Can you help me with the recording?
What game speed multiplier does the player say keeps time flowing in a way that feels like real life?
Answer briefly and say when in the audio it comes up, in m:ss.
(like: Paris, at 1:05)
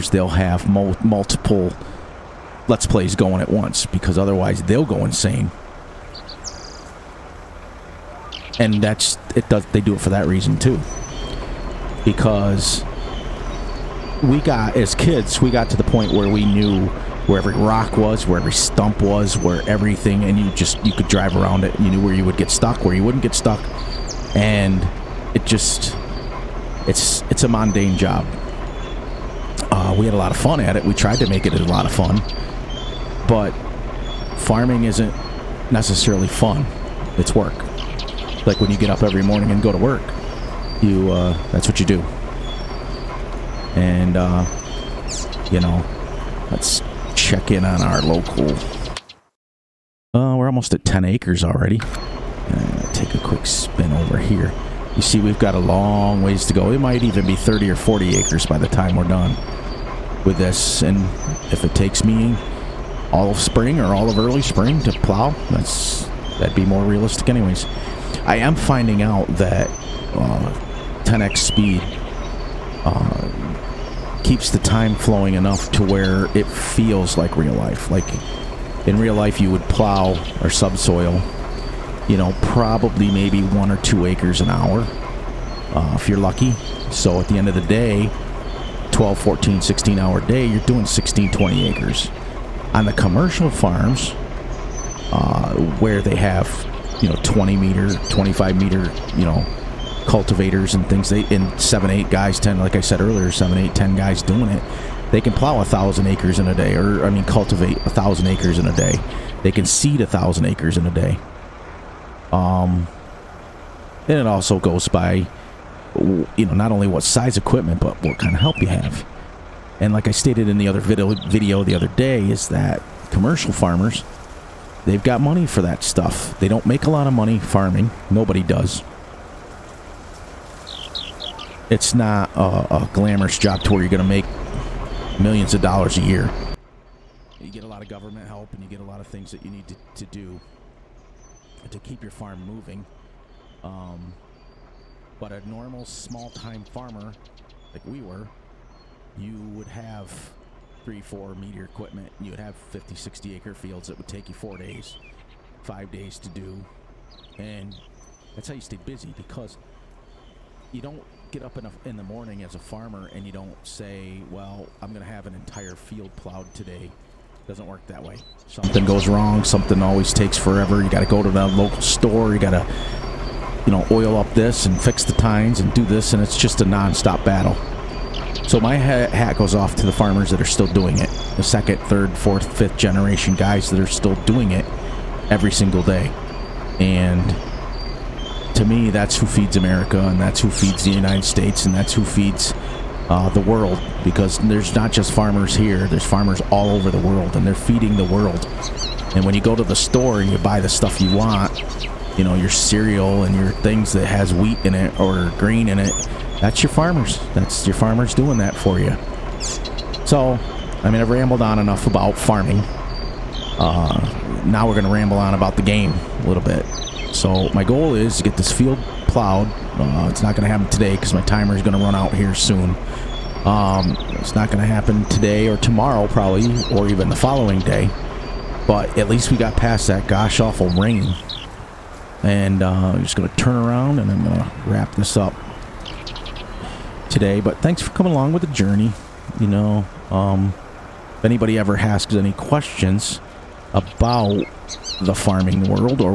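10x, at 1:11.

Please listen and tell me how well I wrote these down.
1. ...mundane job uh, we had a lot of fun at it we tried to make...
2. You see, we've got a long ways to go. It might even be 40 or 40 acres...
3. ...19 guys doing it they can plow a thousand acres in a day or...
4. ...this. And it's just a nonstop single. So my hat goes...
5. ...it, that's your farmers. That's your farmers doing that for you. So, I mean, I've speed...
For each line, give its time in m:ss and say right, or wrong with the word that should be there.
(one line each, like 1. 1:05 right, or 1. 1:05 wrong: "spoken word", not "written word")
1. 0:27 right
2. 0:54 wrong: "30", not "40"
3. 1:43 wrong: "10", not "19"
4. 2:55 wrong: "battle", not "single"
5. 3:25 wrong: "rambled", not "speed".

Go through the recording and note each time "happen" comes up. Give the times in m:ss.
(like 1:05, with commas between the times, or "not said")
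3:40, 3:44.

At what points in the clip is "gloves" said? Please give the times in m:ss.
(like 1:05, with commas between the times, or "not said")
not said.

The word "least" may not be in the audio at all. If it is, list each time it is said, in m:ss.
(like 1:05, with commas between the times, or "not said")
3:49.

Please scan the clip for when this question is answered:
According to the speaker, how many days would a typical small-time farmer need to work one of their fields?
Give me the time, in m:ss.
2:34.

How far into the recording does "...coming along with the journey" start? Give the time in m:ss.
3:57.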